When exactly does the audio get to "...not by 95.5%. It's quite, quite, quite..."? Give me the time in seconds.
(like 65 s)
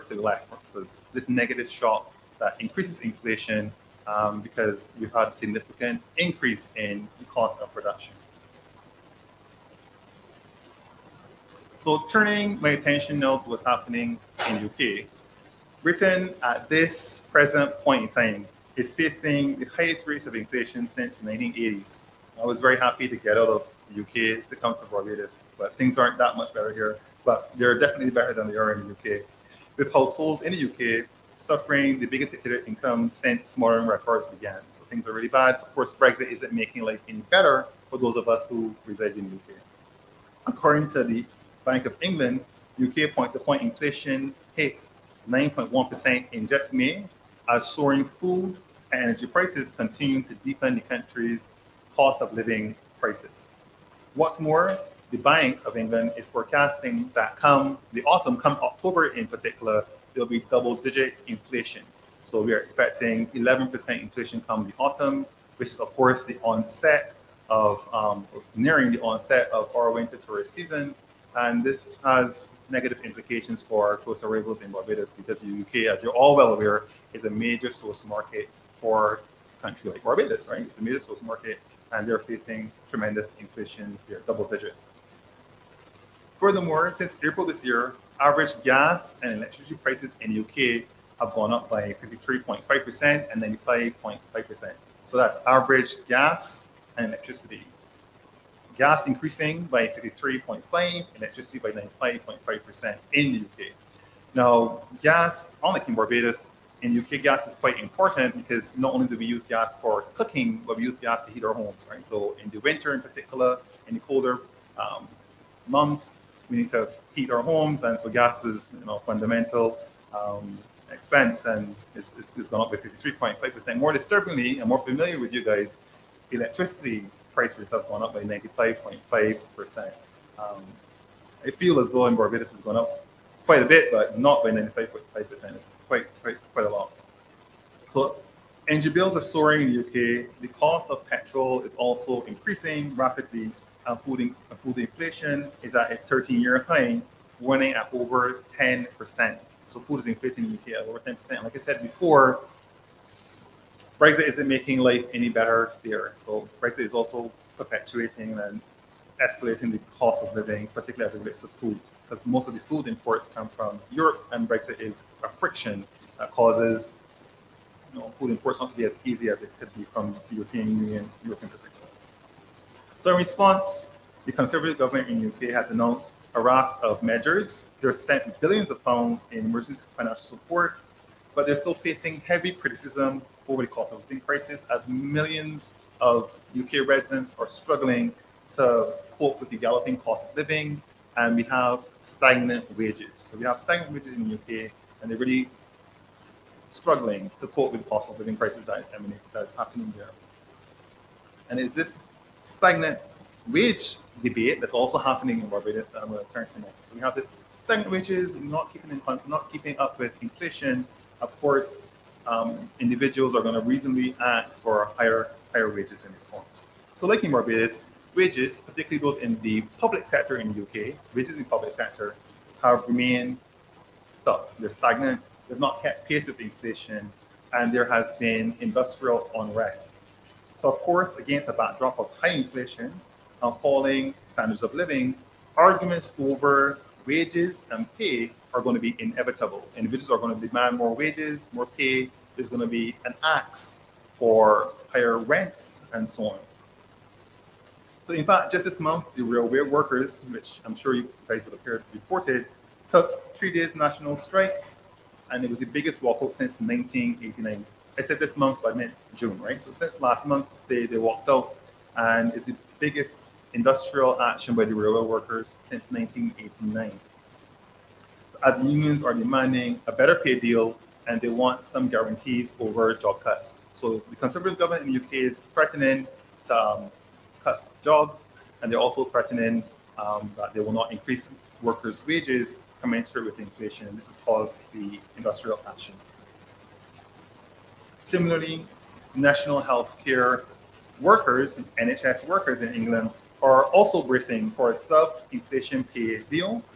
134 s.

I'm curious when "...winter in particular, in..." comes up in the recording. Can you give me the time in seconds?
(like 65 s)
112 s.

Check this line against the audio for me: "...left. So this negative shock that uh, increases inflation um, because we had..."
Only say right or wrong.
right.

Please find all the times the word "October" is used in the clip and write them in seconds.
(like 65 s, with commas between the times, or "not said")
58 s.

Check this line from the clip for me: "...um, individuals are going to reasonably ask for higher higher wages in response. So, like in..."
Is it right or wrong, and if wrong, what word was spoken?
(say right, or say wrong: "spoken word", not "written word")
right.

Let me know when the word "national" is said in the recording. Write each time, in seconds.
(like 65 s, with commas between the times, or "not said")
253 s, 289 s.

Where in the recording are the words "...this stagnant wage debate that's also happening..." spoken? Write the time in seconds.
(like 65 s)
201 s.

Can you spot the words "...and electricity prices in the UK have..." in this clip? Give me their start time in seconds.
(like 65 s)
89 s.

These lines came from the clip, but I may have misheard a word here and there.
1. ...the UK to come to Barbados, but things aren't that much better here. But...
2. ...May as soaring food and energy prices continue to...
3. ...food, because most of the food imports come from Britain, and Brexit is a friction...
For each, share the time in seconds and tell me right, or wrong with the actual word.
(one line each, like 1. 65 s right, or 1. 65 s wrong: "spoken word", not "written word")
1. 23 s right
2. 46 s right
3. 161 s wrong: "Europe", not "Britain".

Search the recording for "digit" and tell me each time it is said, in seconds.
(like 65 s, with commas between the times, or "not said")
60 s, 84 s.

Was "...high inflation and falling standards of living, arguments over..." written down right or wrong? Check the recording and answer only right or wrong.
right.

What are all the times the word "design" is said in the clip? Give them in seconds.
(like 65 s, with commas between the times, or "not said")
not said.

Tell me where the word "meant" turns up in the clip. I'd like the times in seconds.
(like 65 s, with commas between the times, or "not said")
258 s.